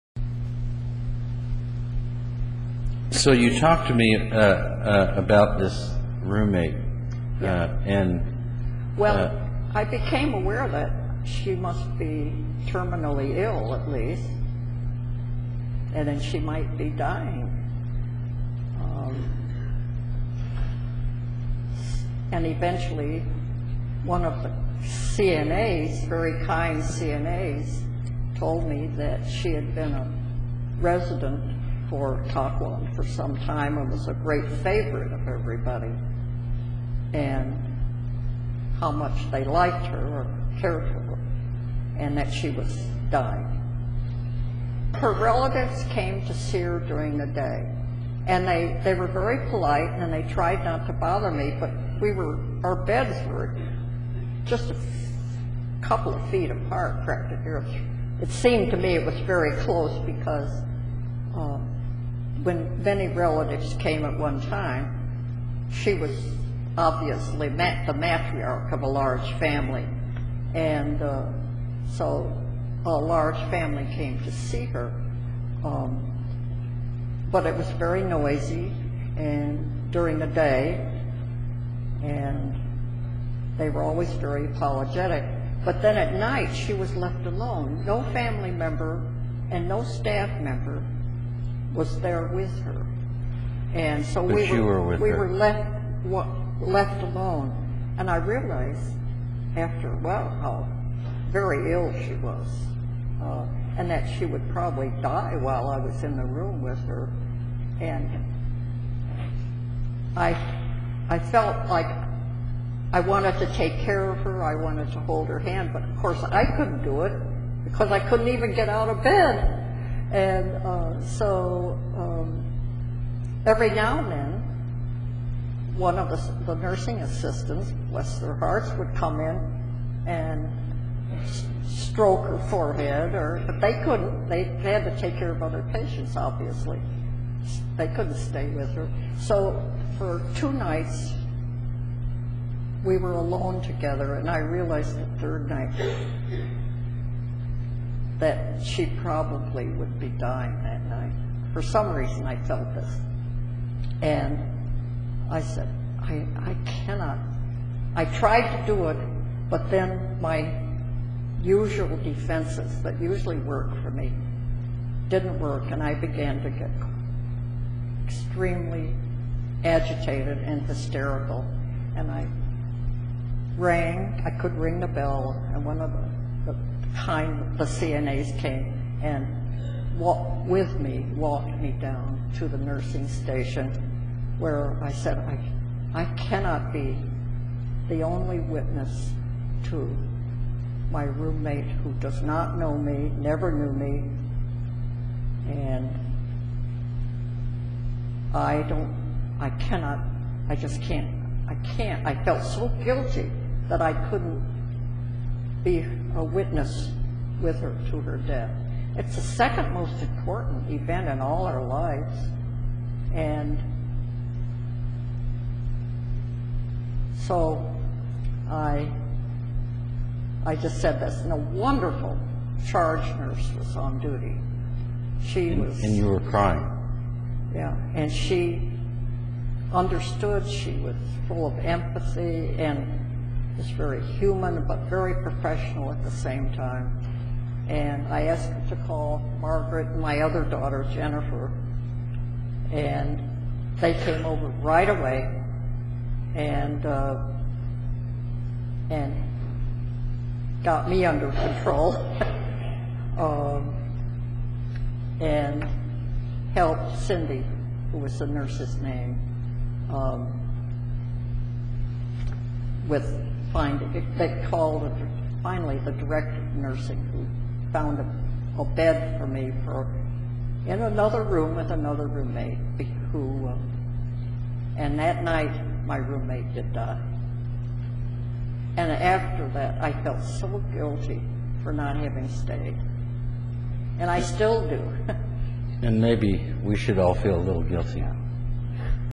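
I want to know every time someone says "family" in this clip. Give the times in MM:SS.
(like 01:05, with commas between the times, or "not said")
01:09, 01:13, 01:28.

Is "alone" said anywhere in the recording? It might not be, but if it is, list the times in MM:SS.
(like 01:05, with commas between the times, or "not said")
01:27, 01:37, 02:23.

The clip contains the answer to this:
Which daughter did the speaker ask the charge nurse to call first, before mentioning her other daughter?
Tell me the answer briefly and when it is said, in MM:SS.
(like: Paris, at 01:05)
Margaret, at 03:59.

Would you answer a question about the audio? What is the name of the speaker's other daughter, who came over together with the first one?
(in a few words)
Jennifer.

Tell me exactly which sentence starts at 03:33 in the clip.
And so I, I just said this, and a wonderful charge nurse was on duty.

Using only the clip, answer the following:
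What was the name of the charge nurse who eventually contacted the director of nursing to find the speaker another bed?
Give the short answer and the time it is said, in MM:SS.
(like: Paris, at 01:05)
Cindy, at 04:16.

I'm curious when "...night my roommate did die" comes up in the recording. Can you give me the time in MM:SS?
04:35.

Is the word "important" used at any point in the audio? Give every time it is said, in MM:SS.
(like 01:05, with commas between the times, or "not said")
03:30.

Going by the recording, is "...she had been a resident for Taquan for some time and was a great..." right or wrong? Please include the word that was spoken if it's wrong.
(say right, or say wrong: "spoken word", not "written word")
right.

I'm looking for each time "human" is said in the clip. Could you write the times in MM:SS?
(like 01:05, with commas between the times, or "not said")
03:54.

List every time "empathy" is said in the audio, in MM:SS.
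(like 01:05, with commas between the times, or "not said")
03:51.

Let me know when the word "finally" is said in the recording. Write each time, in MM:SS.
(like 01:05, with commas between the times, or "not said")
04:25.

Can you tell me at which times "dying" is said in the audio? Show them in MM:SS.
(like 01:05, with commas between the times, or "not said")
00:16, 00:43, 02:30.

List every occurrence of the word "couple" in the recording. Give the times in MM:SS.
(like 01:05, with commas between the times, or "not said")
00:55.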